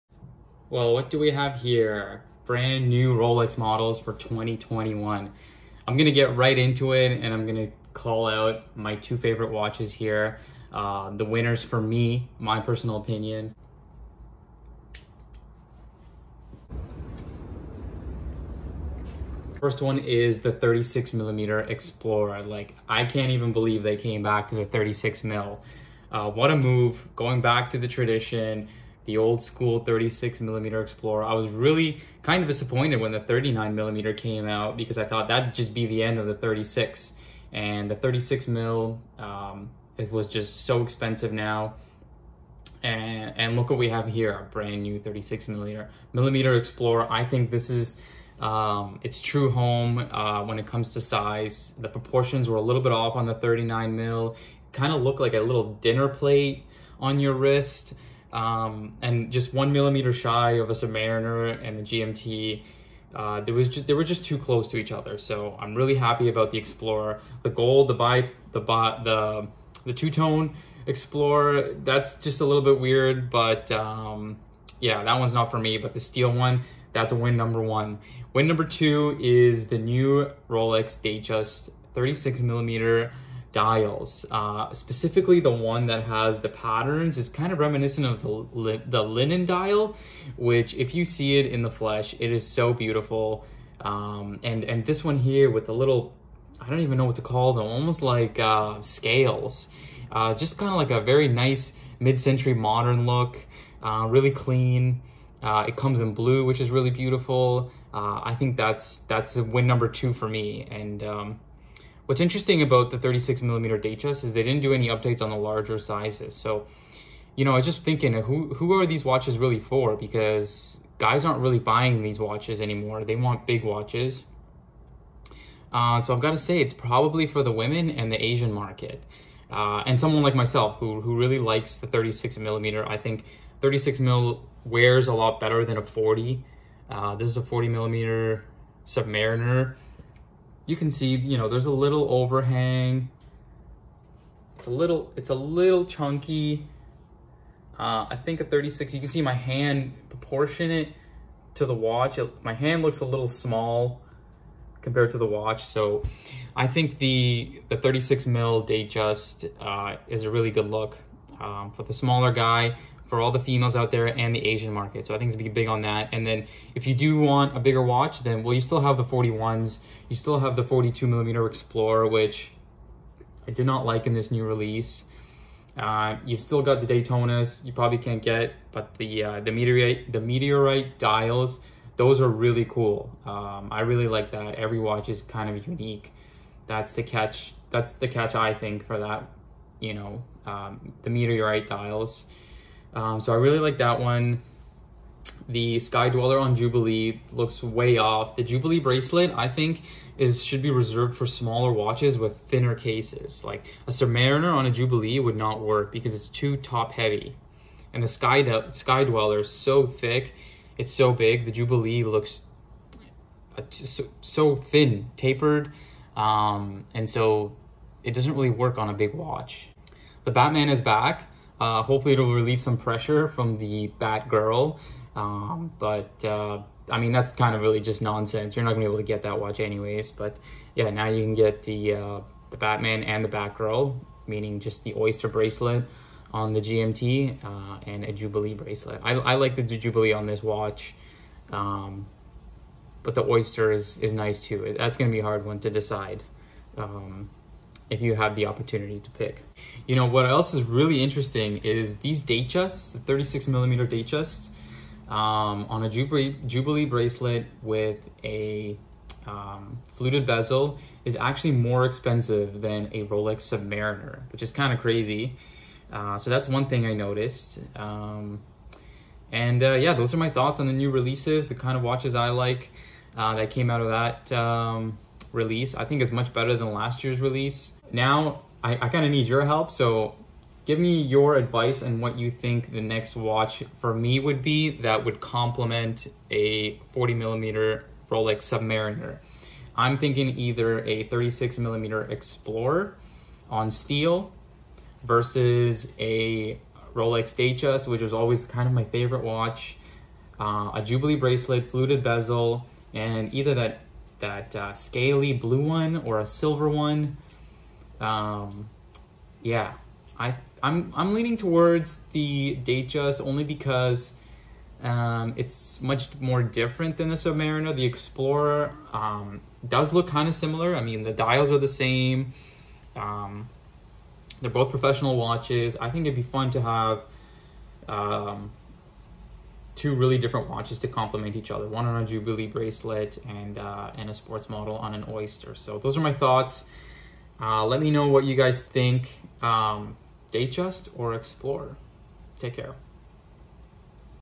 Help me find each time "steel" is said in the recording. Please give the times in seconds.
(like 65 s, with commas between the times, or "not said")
75 s, 293 s.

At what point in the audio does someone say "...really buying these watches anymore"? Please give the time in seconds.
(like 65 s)
121 s.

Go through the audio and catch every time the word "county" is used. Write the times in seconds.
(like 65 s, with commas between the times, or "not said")
not said.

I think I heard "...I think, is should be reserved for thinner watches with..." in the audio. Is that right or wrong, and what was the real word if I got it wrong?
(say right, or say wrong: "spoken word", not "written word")
wrong: "smaller", not "thinner".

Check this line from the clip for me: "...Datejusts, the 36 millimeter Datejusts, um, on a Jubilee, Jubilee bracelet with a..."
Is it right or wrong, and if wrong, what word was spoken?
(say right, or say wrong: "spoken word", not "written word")
right.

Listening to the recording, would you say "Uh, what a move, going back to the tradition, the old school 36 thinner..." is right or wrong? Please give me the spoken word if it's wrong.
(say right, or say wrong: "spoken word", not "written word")
wrong: "millimeter", not "thinner".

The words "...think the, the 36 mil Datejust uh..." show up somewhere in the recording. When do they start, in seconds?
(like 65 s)
156 s.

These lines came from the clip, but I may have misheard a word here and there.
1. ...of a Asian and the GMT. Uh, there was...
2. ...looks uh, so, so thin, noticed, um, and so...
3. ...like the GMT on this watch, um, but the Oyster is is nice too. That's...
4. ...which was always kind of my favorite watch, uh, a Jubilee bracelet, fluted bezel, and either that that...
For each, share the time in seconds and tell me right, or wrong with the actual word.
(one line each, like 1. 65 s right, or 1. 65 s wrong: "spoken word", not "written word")
1. 60 s wrong: "Submariner", not "Asian"
2. 212 s wrong: "tapered", not "noticed"
3. 239 s wrong: "Jubilee", not "GMT"
4. 297 s right.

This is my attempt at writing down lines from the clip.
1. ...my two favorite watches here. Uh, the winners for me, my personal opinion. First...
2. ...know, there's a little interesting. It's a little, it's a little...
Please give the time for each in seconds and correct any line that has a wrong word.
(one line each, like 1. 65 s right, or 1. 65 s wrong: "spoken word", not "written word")
1. 8 s right
2. 141 s wrong: "overhang", not "interesting".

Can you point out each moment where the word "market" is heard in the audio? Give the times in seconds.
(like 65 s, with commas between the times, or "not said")
128 s, 164 s.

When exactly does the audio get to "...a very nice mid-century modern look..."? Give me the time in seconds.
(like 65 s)
100 s.